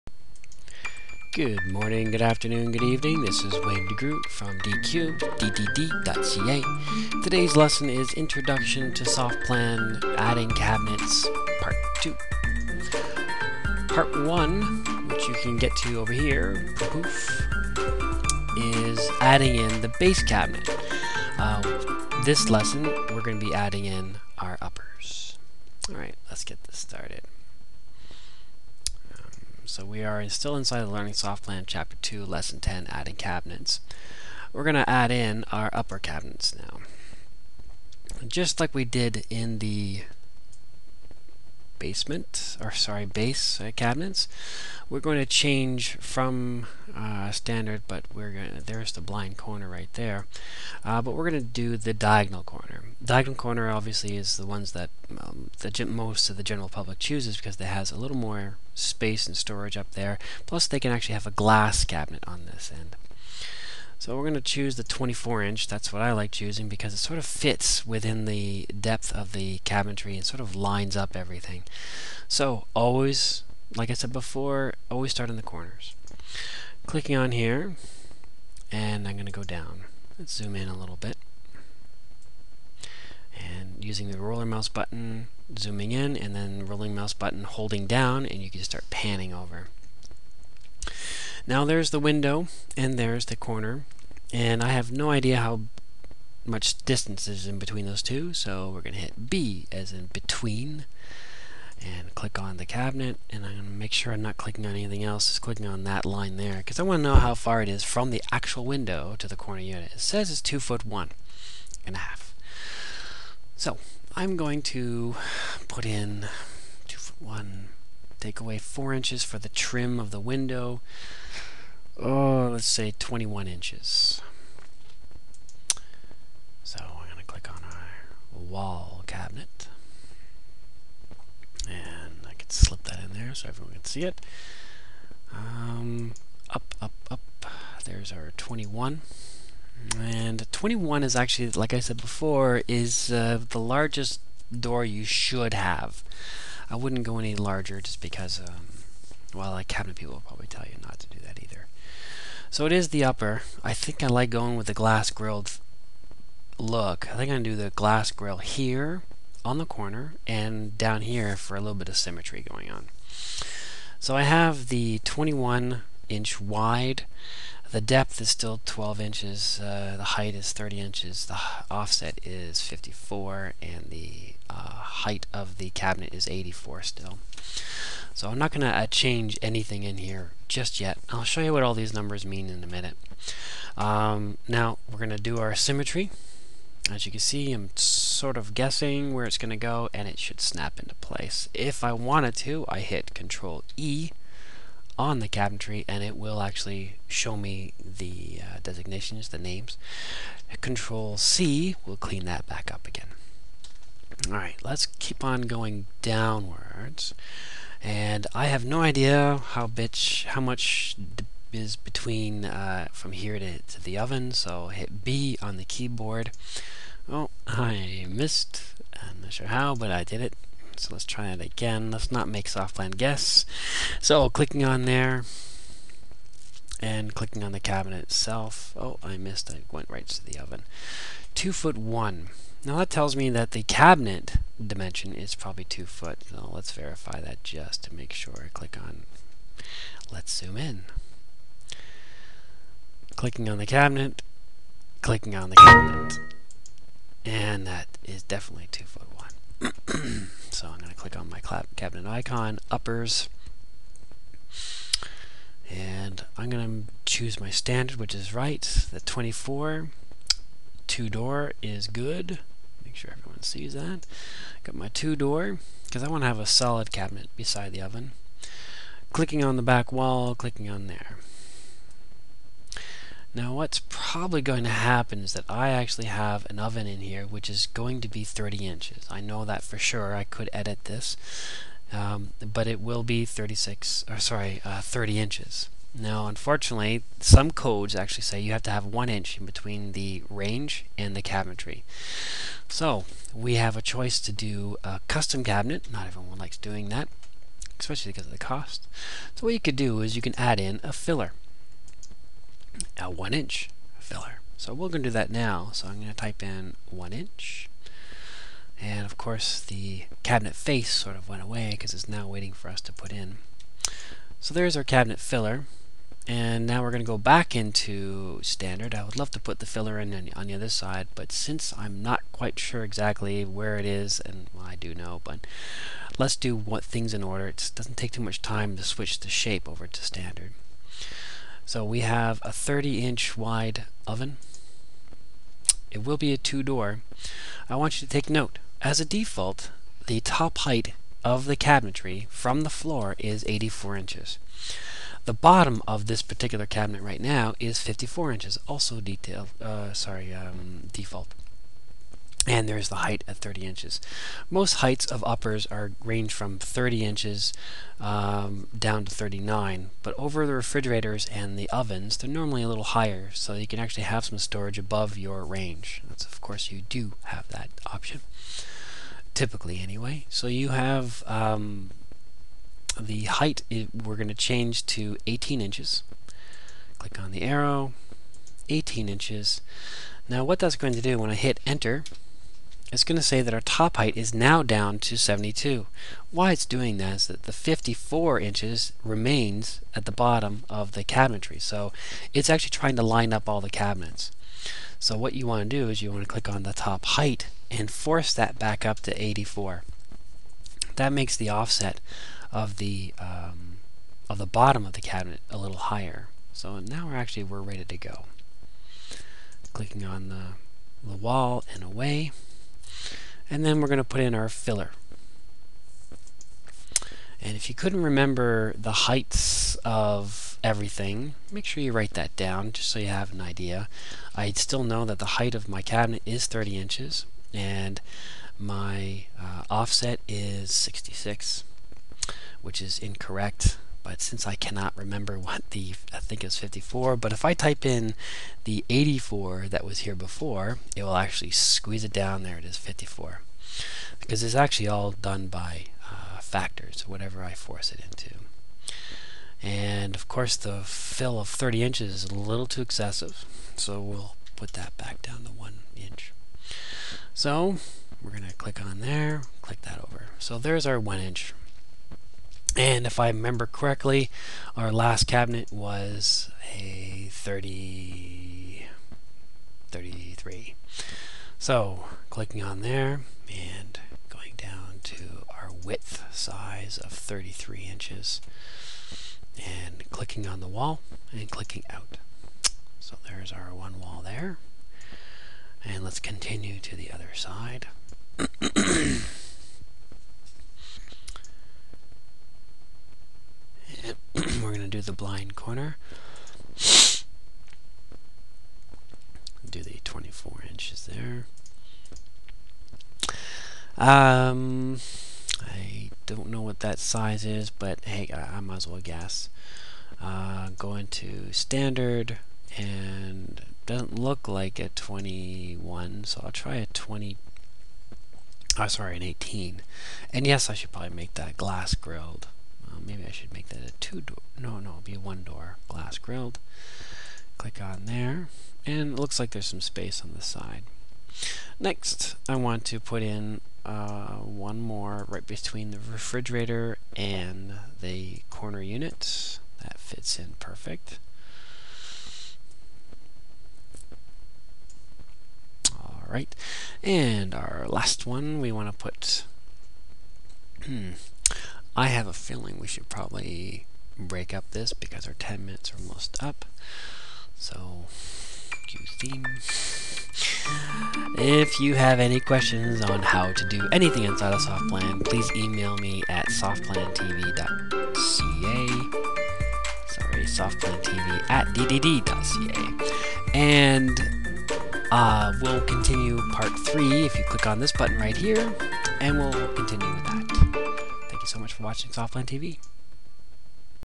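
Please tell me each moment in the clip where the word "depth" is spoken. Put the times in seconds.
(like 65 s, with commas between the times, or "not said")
68 s, 167 s.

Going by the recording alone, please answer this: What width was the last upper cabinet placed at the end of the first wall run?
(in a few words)
33 inches.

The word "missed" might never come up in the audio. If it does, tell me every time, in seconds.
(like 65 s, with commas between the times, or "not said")
218 s, 229 s.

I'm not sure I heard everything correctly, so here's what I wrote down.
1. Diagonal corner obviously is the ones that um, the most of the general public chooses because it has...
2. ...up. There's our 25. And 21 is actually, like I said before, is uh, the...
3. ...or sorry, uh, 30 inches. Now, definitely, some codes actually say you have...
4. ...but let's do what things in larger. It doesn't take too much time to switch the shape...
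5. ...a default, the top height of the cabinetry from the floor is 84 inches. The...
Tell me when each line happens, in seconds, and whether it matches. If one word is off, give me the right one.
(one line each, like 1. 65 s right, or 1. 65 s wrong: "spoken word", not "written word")
1. 53 s right
2. 137 s wrong: "21", not "25"
3. 284 s wrong: "unfortunately", not "definitely"
4. 325 s wrong: "order", not "larger"
5. 338 s right.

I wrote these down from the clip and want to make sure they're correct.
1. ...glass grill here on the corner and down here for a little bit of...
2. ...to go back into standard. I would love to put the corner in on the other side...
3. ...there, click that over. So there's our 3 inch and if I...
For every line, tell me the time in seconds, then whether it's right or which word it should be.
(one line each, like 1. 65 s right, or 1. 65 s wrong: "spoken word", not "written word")
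1. 157 s right
2. 317 s wrong: "filler", not "corner"
3. 458 s wrong: "1", not "3".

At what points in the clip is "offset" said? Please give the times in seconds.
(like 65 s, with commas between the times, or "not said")
171 s, 401 s, 429 s.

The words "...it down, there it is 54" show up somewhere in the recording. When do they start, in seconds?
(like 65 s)
442 s.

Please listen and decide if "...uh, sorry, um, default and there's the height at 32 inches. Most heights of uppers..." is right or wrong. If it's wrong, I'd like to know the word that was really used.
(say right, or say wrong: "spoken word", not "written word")
wrong: "30", not "32".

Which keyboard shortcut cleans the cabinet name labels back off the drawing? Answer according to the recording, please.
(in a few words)
Control C.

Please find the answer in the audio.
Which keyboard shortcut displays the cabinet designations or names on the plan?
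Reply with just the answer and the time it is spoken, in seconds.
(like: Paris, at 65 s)
Control E, at 193 s.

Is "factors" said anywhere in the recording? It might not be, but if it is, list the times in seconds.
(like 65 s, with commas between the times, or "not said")
446 s.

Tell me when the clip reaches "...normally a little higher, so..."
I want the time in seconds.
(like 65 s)
362 s.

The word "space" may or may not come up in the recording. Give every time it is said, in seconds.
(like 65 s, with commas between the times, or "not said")
58 s, 529 s.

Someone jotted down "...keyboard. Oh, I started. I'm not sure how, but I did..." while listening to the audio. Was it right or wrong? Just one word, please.
wrong.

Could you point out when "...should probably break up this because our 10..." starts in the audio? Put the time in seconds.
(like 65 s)
552 s.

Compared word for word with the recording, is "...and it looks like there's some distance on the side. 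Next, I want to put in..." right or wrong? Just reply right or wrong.
wrong.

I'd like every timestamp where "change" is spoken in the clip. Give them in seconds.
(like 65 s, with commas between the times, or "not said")
45 s, 178 s, 374 s.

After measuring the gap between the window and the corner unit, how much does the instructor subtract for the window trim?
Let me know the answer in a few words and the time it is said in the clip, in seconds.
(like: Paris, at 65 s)
4 inches, at 118 s.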